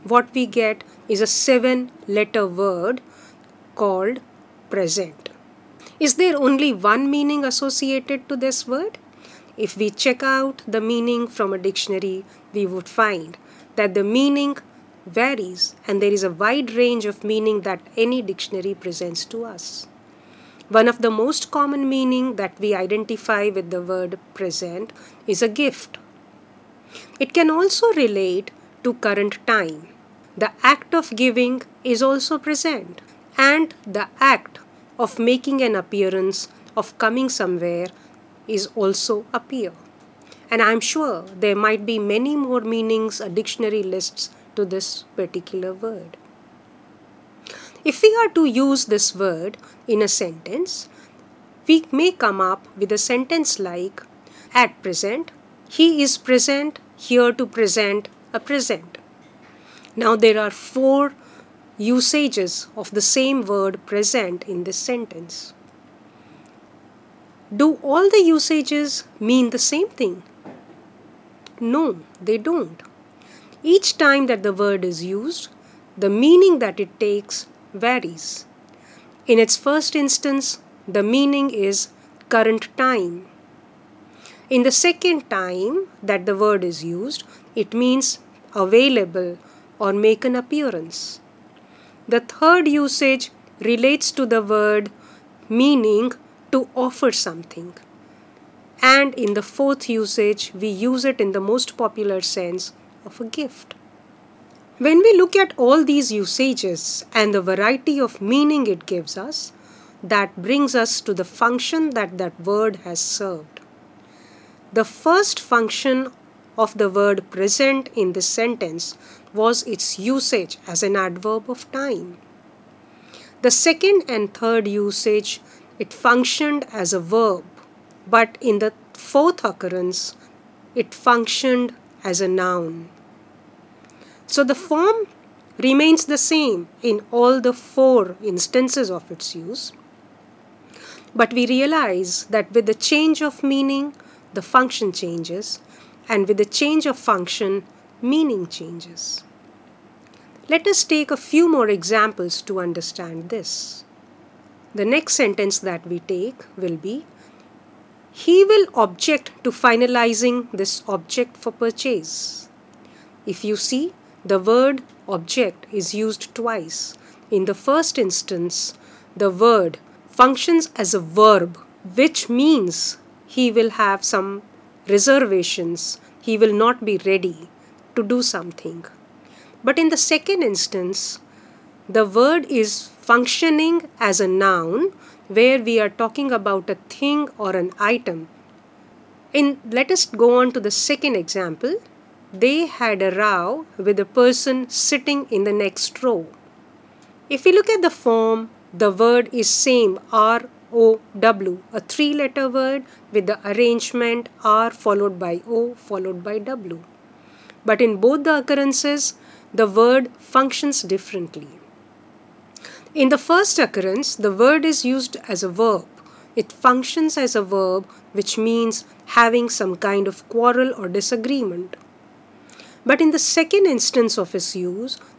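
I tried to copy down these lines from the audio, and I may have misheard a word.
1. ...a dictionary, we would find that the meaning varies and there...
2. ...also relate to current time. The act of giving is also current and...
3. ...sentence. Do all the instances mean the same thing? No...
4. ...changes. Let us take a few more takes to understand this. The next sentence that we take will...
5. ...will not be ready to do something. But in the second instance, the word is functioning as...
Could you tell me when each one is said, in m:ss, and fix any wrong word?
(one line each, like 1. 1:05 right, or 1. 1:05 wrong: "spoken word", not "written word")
1. 0:11 right
2. 0:27 wrong: "present", not "current"
3. 1:04 wrong: "usages", not "instances"
4. 2:28 wrong: "examples", not "takes"
5. 2:56 right.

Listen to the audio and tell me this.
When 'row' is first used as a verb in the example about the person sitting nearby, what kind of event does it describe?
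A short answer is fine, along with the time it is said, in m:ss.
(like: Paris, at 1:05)
quarrel or disagreement, at 3:40.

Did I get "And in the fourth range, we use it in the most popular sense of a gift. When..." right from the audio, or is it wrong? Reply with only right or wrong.
wrong.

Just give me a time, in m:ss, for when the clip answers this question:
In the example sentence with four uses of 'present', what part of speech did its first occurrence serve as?
2:00.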